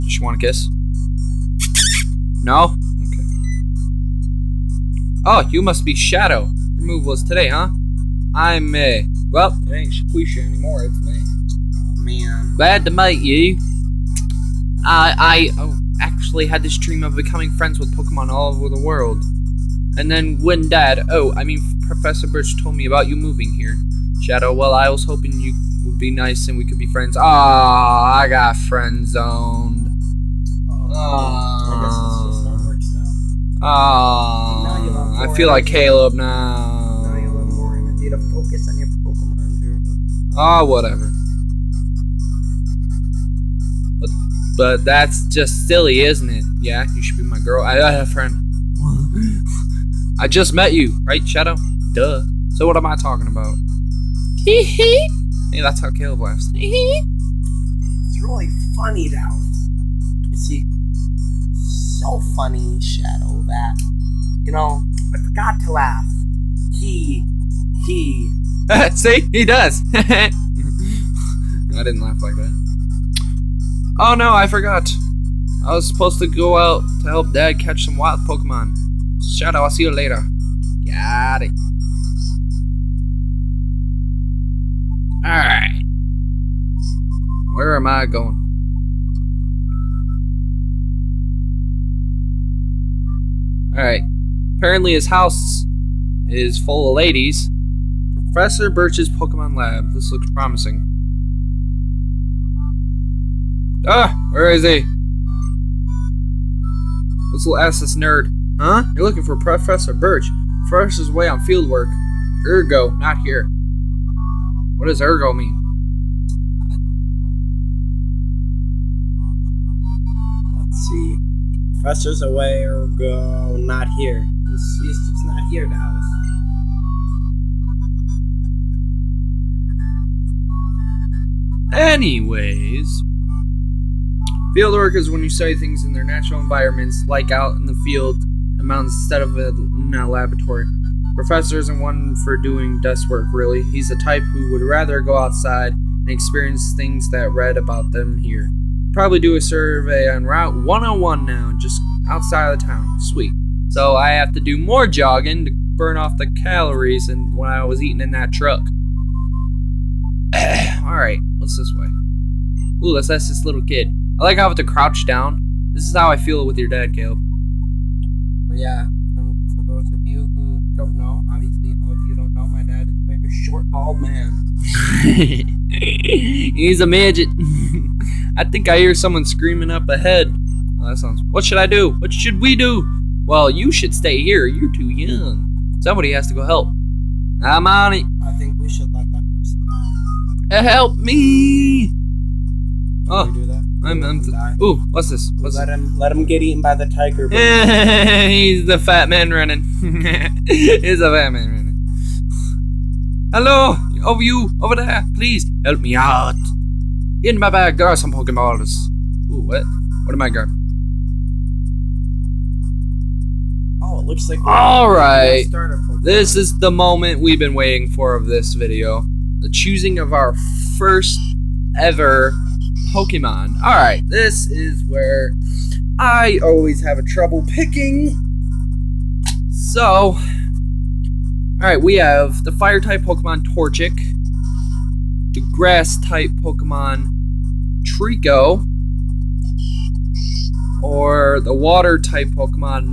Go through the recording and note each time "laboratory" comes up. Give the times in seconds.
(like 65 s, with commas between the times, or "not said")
140 s.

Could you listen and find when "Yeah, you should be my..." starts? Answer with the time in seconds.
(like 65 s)
46 s.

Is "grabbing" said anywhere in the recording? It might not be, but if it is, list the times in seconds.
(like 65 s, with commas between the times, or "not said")
210 s.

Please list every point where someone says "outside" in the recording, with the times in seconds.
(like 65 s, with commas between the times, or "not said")
145 s, 152 s.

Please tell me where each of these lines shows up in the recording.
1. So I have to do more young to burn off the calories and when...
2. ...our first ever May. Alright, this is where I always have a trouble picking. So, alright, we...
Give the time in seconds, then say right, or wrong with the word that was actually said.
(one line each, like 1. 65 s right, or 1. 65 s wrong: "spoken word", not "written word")
1. 153 s wrong: "jogging", not "young"
2. 220 s wrong: "Pokemon", not "May".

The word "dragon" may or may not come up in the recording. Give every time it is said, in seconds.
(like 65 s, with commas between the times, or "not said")
not said.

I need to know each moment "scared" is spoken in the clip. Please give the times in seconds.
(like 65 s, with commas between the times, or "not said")
not said.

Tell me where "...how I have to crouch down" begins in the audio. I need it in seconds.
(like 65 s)
164 s.